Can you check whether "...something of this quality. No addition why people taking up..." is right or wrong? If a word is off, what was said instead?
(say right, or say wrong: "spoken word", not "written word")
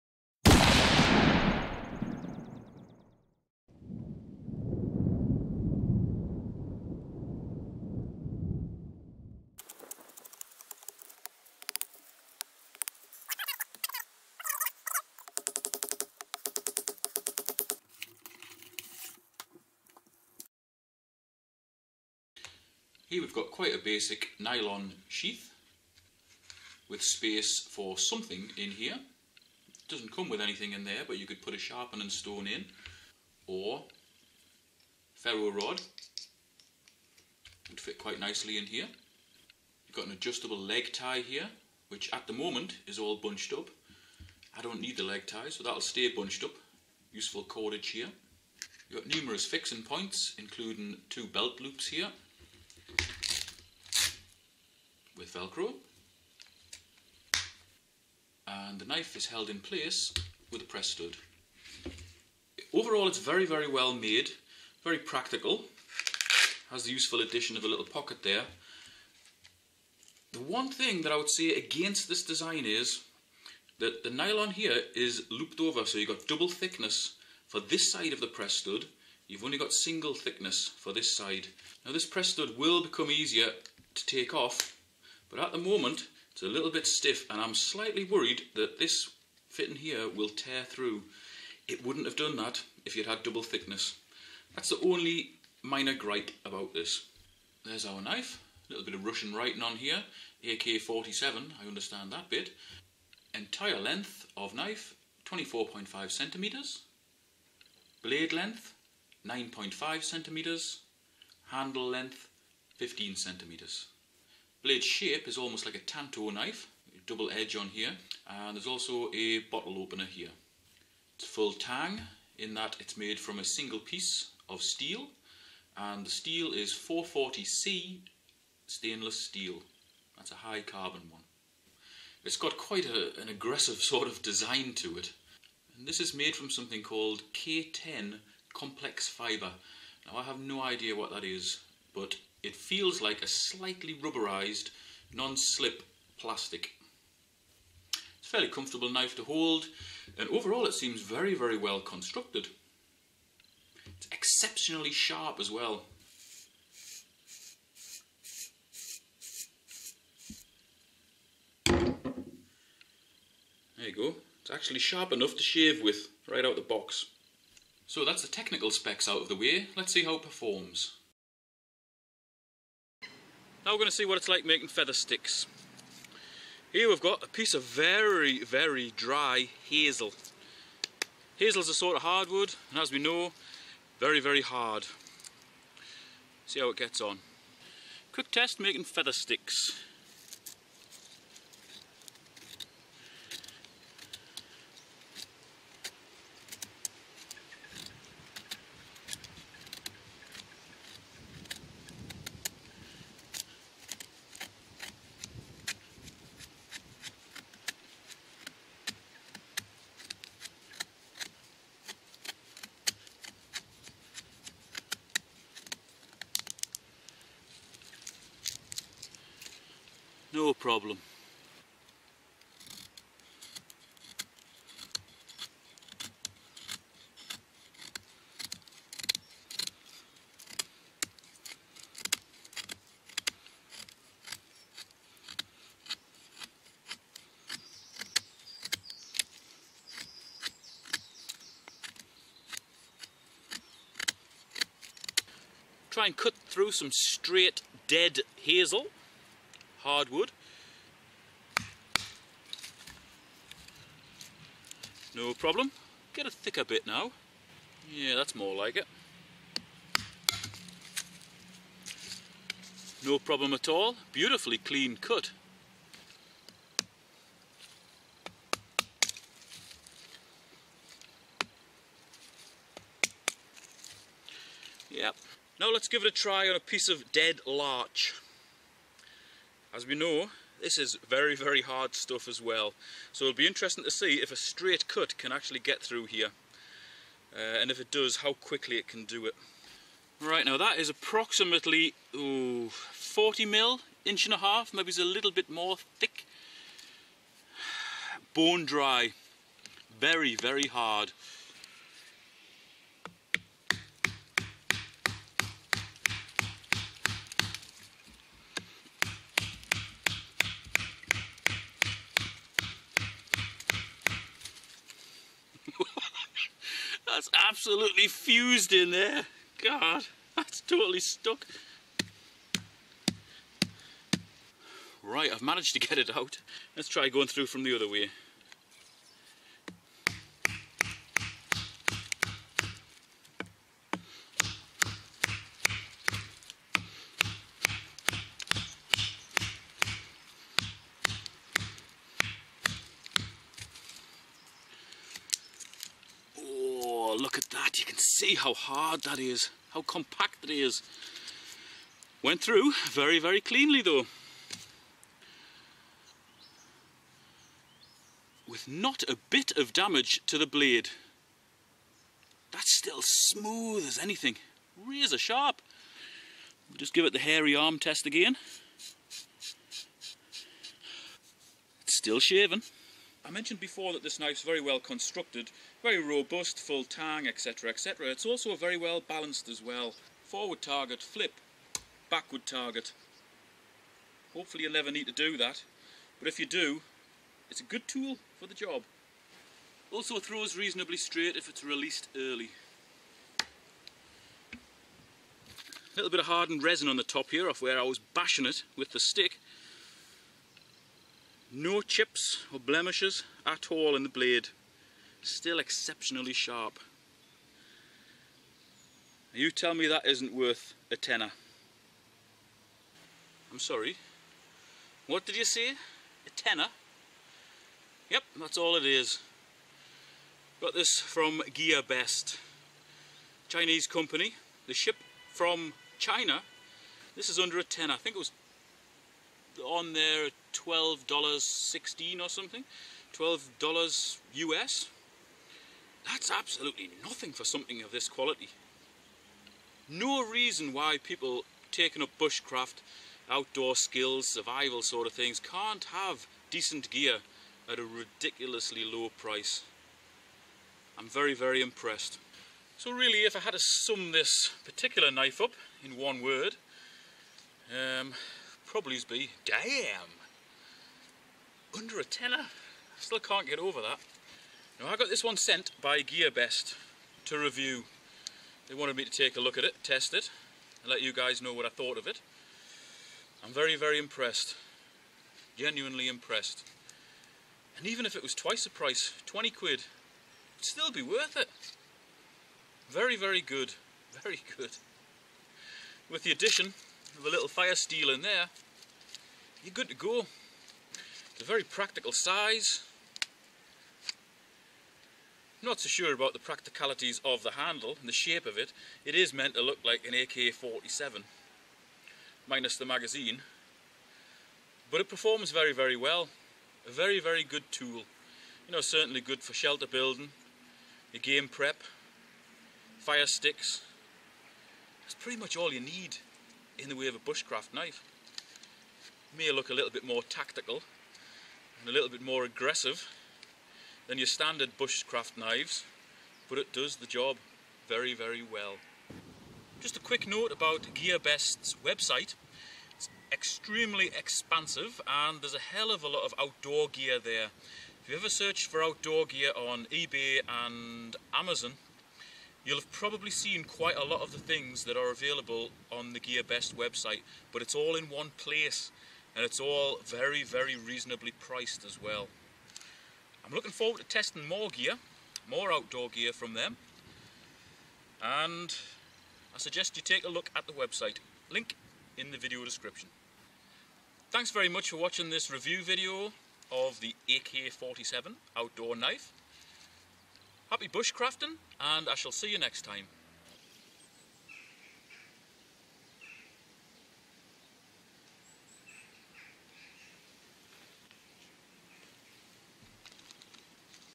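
wrong: "reason", not "addition".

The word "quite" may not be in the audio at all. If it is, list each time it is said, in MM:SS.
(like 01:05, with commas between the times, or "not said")
00:23, 00:37, 02:12, 09:03.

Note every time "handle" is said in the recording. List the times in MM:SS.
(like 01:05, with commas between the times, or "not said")
01:51, 08:17.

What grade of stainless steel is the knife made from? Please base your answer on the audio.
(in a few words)
440C.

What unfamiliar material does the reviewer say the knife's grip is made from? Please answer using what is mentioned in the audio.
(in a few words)
K10 complex fibre.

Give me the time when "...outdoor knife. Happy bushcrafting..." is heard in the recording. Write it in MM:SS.
09:28.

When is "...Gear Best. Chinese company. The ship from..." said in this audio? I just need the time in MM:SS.
07:01.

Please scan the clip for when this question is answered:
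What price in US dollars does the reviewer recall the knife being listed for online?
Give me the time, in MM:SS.
07:10.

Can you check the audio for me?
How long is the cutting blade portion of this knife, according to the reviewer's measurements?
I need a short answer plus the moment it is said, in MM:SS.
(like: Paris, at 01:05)
9.5 centimetres, at 01:49.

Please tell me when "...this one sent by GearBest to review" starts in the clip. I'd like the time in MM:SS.
07:45.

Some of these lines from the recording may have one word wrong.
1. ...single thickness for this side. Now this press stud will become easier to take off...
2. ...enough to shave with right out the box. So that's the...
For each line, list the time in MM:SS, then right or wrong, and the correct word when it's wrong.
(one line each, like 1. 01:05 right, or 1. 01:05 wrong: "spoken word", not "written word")
1. 01:19 right
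2. 02:45 right.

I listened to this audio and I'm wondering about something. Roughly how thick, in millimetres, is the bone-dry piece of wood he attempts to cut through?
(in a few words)
40 mm.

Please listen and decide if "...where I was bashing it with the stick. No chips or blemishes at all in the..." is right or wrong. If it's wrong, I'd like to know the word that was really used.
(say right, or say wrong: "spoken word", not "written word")
right.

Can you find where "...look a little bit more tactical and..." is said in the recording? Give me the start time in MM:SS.
08:39.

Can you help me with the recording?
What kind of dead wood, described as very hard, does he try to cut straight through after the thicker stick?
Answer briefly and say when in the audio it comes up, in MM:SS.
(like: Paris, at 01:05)
larch, at 04:37.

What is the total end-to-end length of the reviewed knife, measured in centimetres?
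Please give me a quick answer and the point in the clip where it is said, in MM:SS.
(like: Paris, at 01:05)
24.5 centimetres, at 01:45.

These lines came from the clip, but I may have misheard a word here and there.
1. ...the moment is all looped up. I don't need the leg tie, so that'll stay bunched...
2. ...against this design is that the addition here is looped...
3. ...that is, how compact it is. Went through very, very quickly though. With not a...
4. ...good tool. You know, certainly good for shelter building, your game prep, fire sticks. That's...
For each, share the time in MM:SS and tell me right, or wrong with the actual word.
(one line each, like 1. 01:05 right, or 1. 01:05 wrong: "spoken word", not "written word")
1. 00:42 wrong: "bunched", not "looped"
2. 01:11 wrong: "nylon", not "addition"
3. 05:49 wrong: "cleanly", not "quickly"
4. 08:27 right.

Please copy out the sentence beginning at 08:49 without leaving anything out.
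Just a quick note about GearBest's website.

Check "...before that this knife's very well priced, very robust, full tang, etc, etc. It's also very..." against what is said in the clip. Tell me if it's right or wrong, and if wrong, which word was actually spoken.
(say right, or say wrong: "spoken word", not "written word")
wrong: "constructed", not "priced".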